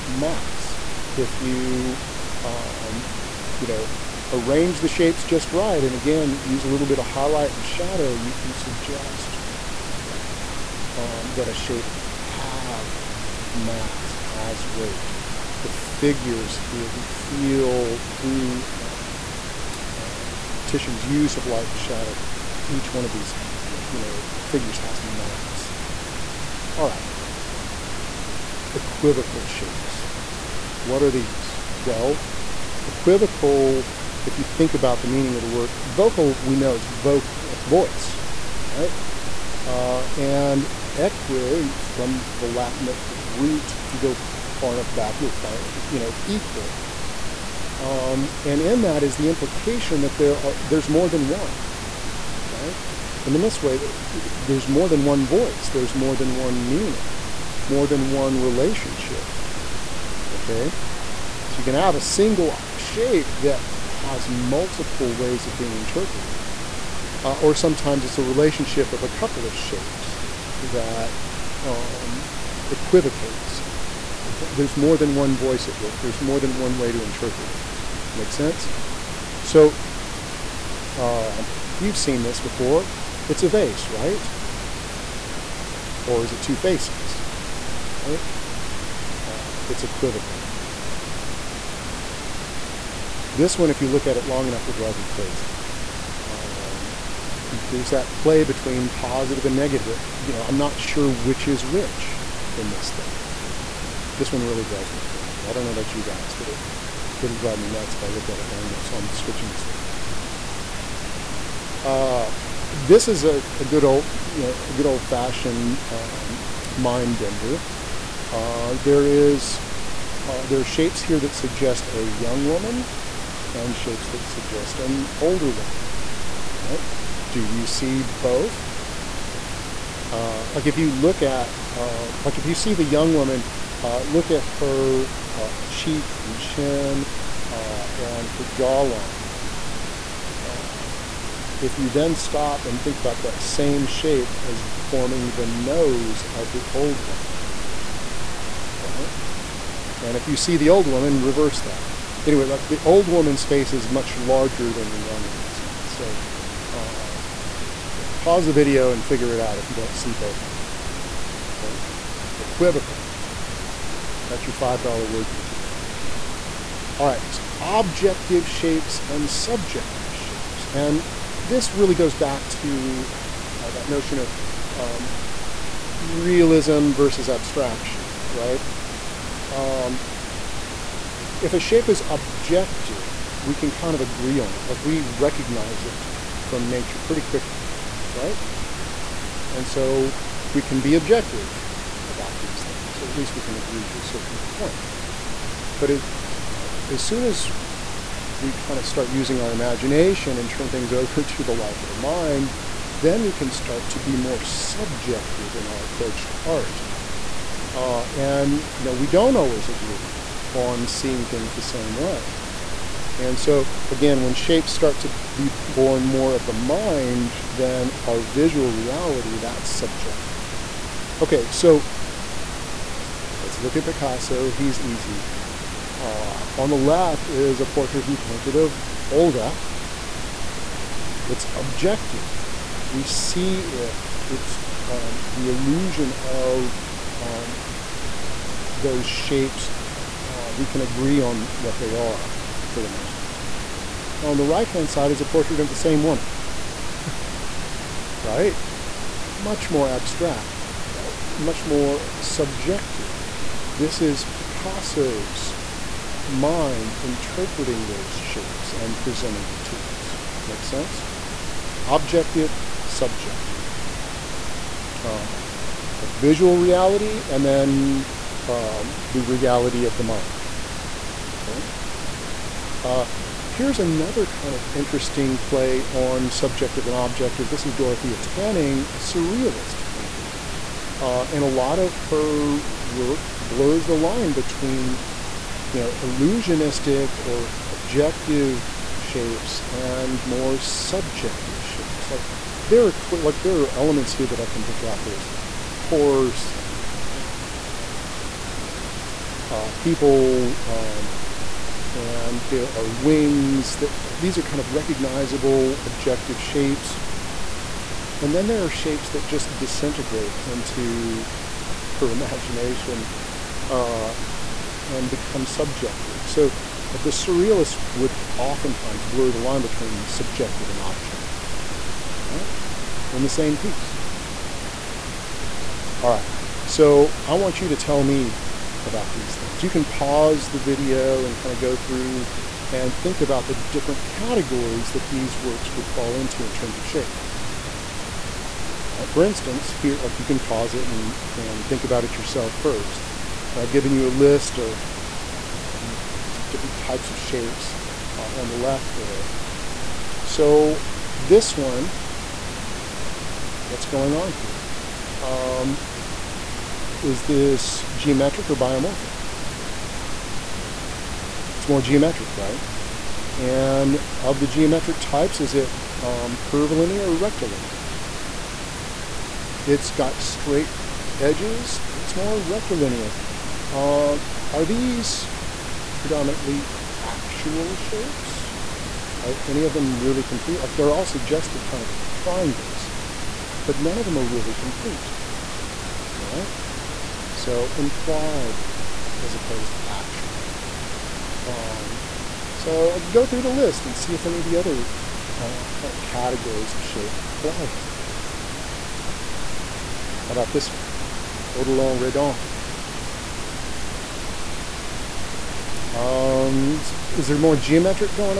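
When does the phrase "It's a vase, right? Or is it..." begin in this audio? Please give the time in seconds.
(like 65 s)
83 s.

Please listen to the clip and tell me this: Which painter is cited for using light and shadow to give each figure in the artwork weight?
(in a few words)
Titian.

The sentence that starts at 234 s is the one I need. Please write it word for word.
It's um, the illusion of um, those shapes, uh, we can agree on what they are for the most part.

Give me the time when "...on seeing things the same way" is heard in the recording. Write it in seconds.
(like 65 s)
210 s.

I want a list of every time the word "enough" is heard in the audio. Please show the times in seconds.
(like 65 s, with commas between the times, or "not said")
44 s, 94 s, 108 s.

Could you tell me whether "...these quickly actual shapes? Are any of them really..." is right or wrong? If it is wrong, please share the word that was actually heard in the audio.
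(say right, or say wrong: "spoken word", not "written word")
wrong: "predominantly", not "quickly".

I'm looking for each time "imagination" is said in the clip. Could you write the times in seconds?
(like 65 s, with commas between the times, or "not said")
199 s, 312 s.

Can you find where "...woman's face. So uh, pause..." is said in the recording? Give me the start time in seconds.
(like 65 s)
155 s.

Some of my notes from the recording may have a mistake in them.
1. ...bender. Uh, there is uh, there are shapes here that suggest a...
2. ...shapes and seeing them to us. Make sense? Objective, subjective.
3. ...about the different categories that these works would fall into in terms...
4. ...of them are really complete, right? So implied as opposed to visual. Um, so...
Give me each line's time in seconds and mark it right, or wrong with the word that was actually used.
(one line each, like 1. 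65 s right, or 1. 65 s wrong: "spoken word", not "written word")
1. 117 s right
2. 258 s wrong: "presenting", not "seeing"
3. 333 s right
4. 383 s wrong: "actual", not "visual".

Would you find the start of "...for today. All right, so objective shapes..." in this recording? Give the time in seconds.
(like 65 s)
165 s.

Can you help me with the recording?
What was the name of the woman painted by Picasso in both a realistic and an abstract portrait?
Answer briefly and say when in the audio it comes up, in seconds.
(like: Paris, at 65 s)
Olga, at 229 s.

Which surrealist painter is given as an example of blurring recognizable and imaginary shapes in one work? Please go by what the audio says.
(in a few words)
Dorothea Tanning.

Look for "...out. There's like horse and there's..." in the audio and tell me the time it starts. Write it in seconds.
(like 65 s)
294 s.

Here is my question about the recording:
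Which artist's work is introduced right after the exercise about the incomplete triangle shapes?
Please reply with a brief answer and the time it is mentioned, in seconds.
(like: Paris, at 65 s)
Odilon Redon, at 401 s.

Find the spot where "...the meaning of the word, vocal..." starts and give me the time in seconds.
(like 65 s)
34 s.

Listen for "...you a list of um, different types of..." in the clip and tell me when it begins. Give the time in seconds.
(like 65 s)
343 s.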